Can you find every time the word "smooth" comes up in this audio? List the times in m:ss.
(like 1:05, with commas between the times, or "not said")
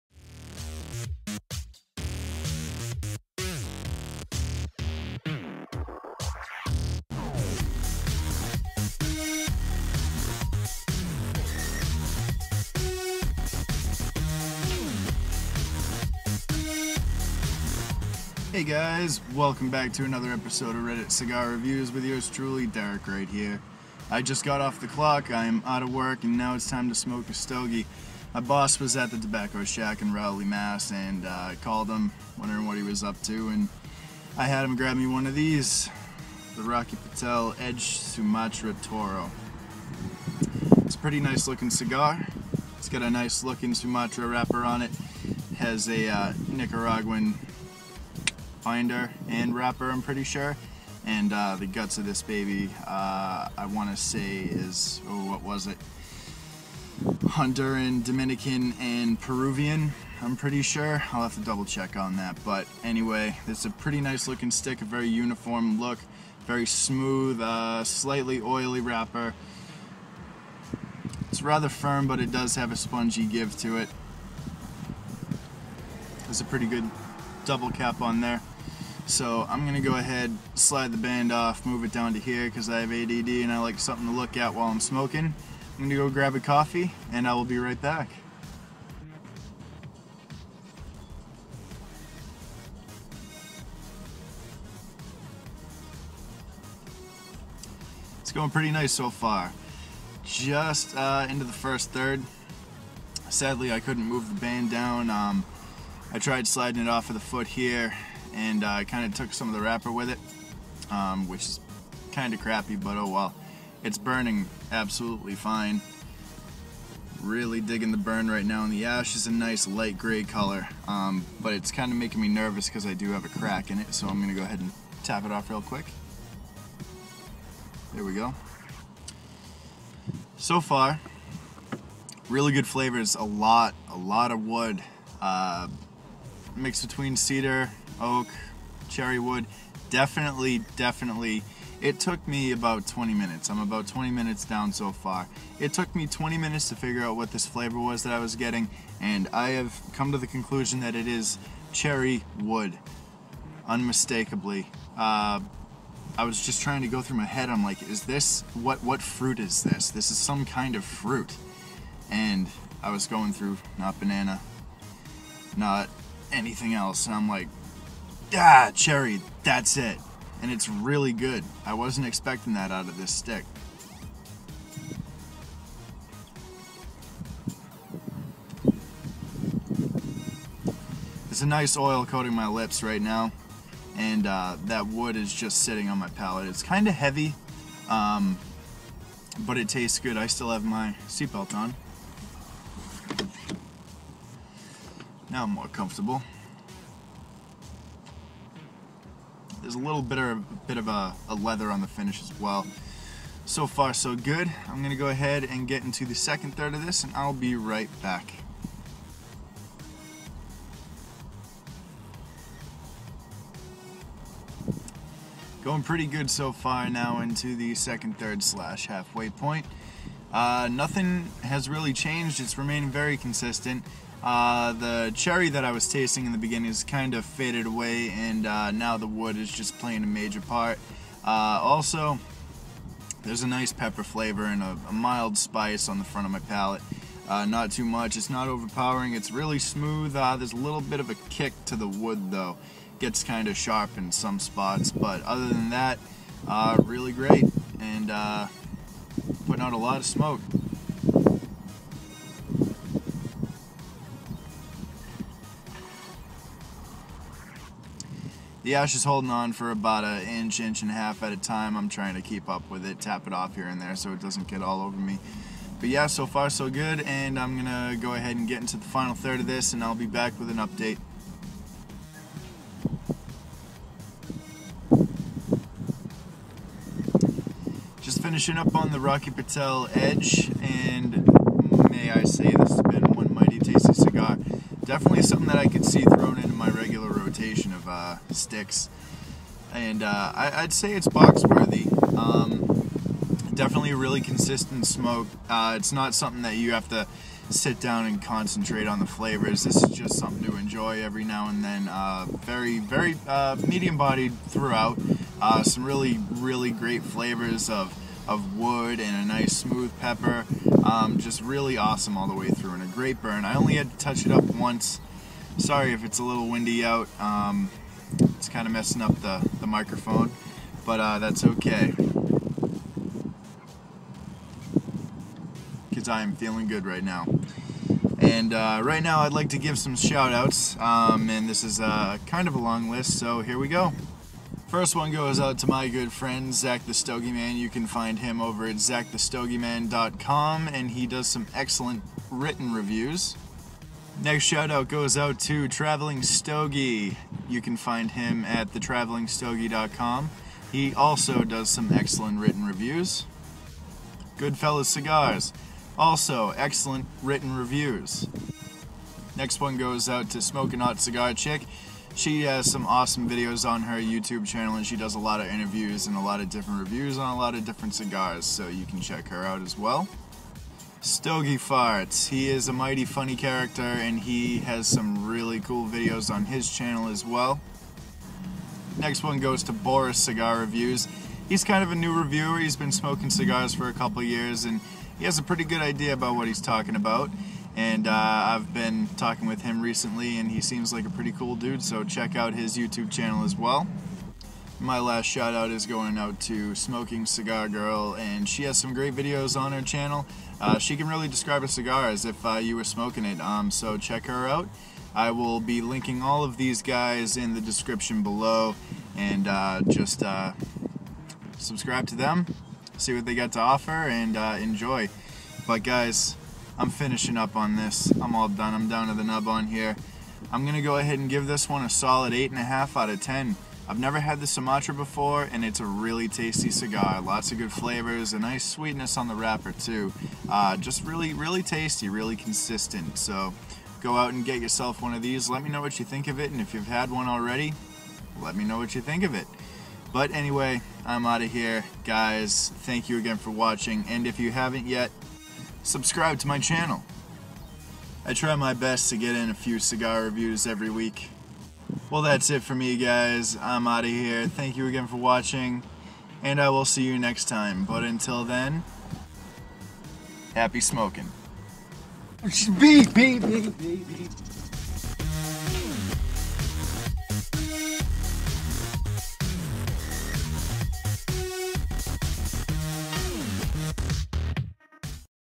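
1:06, 3:59, 5:09.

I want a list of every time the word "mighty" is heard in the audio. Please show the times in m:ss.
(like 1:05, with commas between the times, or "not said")
4:43, 6:12.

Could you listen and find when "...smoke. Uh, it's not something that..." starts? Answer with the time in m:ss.
4:54.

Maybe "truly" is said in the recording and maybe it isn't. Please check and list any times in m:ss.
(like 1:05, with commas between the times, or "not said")
0:22.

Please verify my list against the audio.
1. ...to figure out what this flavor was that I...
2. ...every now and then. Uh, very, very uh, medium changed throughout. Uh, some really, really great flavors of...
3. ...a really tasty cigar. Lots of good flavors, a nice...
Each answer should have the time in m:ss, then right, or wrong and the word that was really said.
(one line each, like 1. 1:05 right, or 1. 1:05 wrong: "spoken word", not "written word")
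1. 2:26 right
2. 5:01 wrong: "bodied", not "changed"
3. 7:05 right.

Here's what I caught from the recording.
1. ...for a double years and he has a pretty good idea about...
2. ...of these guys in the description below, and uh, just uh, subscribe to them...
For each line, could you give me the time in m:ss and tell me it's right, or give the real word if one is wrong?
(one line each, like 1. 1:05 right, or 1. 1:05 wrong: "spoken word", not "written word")
1. 6:23 wrong: "couple", not "double"
2. 6:46 right.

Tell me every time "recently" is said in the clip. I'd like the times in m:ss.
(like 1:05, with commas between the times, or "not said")
6:29.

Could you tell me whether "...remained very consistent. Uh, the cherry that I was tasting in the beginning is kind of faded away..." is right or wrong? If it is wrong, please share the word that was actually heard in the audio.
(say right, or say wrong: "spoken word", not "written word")
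right.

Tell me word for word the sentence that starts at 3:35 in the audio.
Going pretty good so far now into the second third slash halfway point.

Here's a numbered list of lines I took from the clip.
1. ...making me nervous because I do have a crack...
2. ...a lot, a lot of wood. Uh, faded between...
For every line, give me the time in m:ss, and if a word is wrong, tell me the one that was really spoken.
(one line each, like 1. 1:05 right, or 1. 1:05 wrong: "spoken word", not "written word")
1. 2:01 right
2. 2:13 wrong: "mixed", not "faded".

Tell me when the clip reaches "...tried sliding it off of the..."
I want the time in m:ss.
1:46.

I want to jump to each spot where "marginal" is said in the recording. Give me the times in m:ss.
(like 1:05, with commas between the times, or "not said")
not said.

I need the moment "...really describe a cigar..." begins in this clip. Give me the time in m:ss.
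6:41.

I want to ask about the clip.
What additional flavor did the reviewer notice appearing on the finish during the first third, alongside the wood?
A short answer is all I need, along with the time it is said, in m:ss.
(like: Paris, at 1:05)
Leather, at 3:21.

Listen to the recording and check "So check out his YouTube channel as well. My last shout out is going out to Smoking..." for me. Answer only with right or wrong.
right.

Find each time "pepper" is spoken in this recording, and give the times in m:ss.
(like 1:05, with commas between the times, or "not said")
3:53, 5:09.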